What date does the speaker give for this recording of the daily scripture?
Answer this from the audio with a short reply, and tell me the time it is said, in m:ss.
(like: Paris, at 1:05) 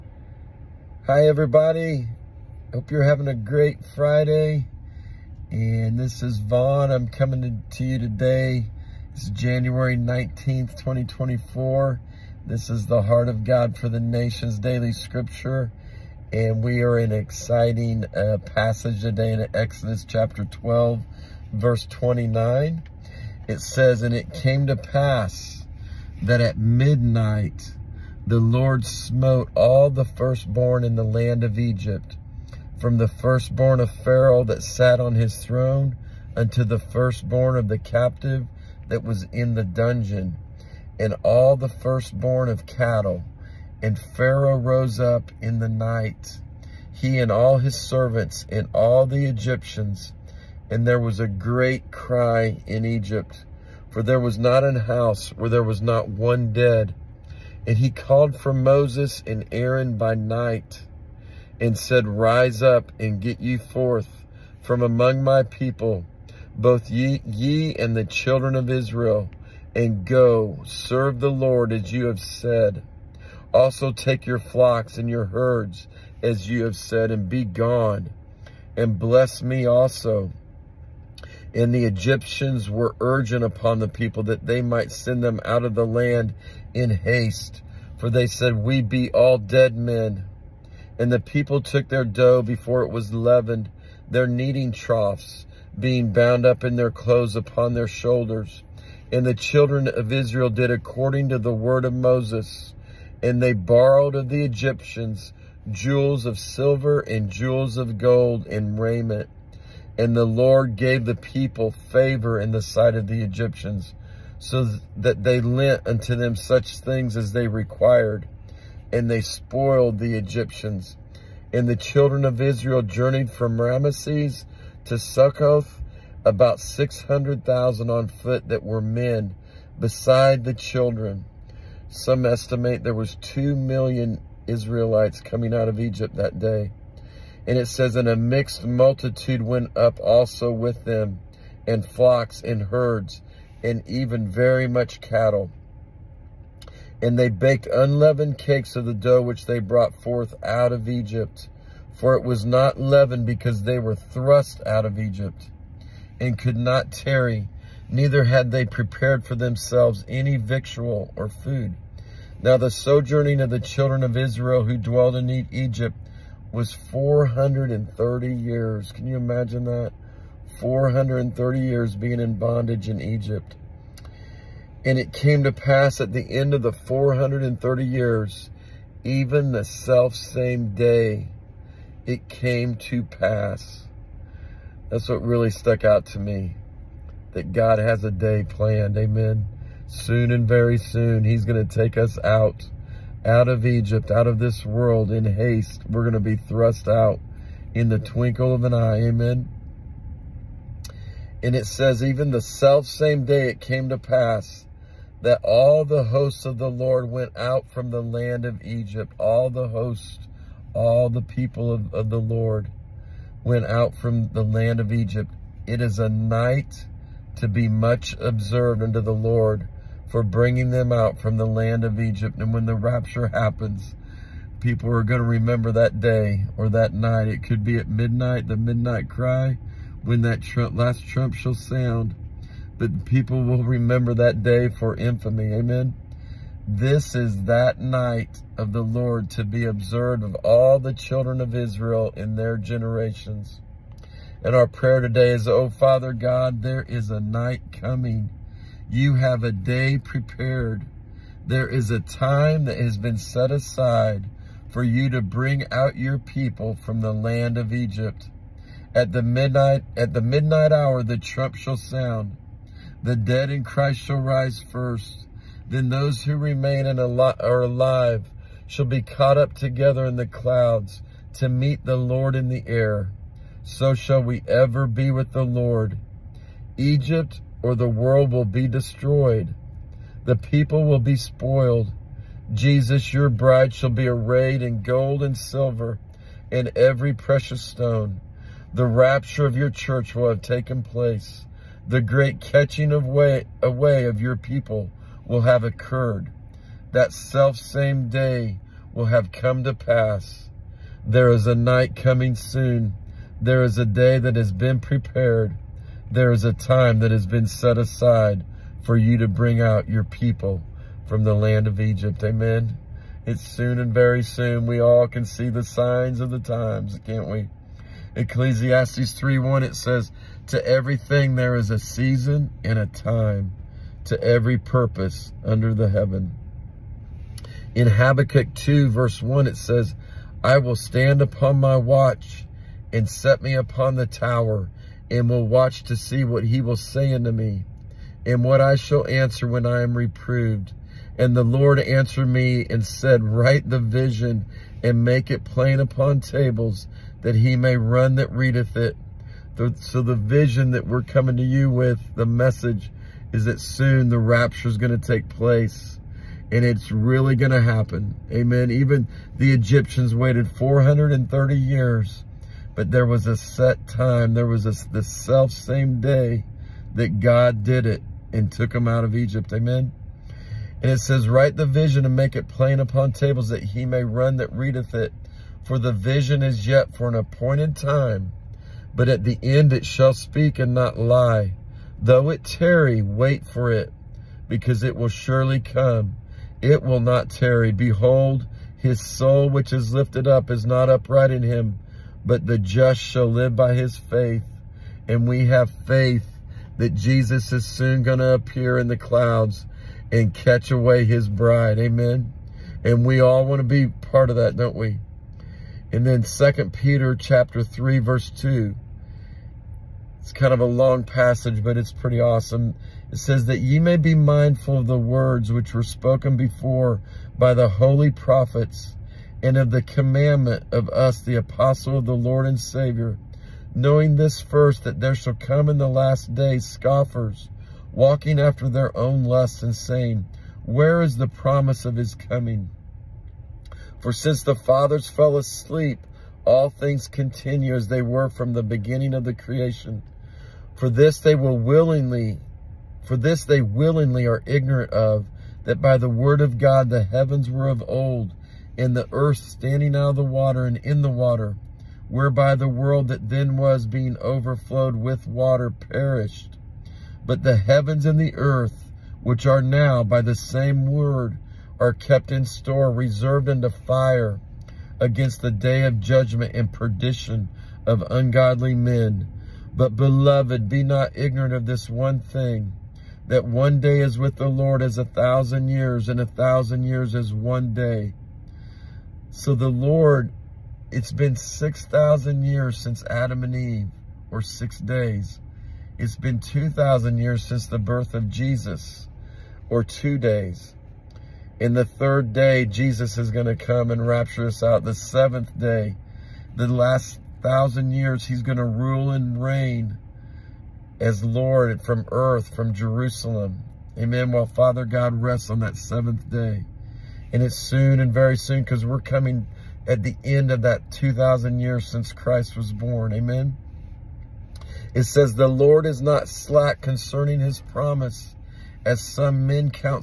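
January 19th, 2024, at 0:09.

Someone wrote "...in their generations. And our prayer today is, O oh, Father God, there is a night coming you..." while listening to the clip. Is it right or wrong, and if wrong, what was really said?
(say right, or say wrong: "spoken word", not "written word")
right.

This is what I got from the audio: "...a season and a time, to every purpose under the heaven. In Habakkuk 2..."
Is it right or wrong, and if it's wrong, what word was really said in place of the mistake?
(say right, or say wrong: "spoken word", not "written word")
right.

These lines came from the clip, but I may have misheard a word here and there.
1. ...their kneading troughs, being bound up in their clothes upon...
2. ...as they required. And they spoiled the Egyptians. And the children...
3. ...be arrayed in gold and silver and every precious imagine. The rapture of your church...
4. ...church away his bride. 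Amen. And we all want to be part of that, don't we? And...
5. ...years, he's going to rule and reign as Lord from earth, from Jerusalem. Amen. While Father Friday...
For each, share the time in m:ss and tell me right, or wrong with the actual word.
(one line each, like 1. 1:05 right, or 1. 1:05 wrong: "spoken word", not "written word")
1. 1:34 right
2. 1:57 right
3. 4:43 wrong: "stone", not "imagine"
4. 6:40 wrong: "catch", not "church"
5. 8:17 wrong: "God", not "Friday".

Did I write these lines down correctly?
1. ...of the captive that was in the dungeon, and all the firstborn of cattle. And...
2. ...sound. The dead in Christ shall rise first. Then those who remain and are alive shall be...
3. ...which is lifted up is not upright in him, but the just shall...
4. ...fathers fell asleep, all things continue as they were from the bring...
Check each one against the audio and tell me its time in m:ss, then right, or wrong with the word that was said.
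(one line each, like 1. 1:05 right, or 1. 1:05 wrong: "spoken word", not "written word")
1. 0:37 right
2. 4:21 right
3. 6:29 right
4. 7:14 wrong: "beginning", not "bring".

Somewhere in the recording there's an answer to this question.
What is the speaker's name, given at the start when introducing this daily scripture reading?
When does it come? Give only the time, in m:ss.
0:06.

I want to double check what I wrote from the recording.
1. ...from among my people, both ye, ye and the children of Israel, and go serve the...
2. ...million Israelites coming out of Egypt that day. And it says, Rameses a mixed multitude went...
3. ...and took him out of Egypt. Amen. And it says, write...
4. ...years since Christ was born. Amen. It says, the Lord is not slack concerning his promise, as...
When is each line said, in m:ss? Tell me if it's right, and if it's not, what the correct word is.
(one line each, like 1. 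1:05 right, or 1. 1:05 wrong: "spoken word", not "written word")
1. 1:04 right
2. 2:13 wrong: "And", not "Rameses"
3. 6:08 right
4. 8:31 right.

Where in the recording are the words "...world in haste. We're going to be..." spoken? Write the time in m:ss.
3:14.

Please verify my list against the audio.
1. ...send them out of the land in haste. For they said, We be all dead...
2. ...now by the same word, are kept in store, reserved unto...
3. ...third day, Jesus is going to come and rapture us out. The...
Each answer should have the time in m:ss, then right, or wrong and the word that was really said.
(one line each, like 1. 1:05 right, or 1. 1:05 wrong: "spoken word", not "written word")
1. 1:24 right
2. 7:39 right
3. 8:11 right.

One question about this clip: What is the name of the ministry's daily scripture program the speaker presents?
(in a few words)
Heart of God for the Nations.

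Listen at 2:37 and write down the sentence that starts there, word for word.
Neither had they prepared for themselves any victual or food.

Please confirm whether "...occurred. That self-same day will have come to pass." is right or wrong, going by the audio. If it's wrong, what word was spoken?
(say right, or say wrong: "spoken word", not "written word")
right.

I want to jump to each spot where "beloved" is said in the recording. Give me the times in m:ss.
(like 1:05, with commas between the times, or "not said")
7:49.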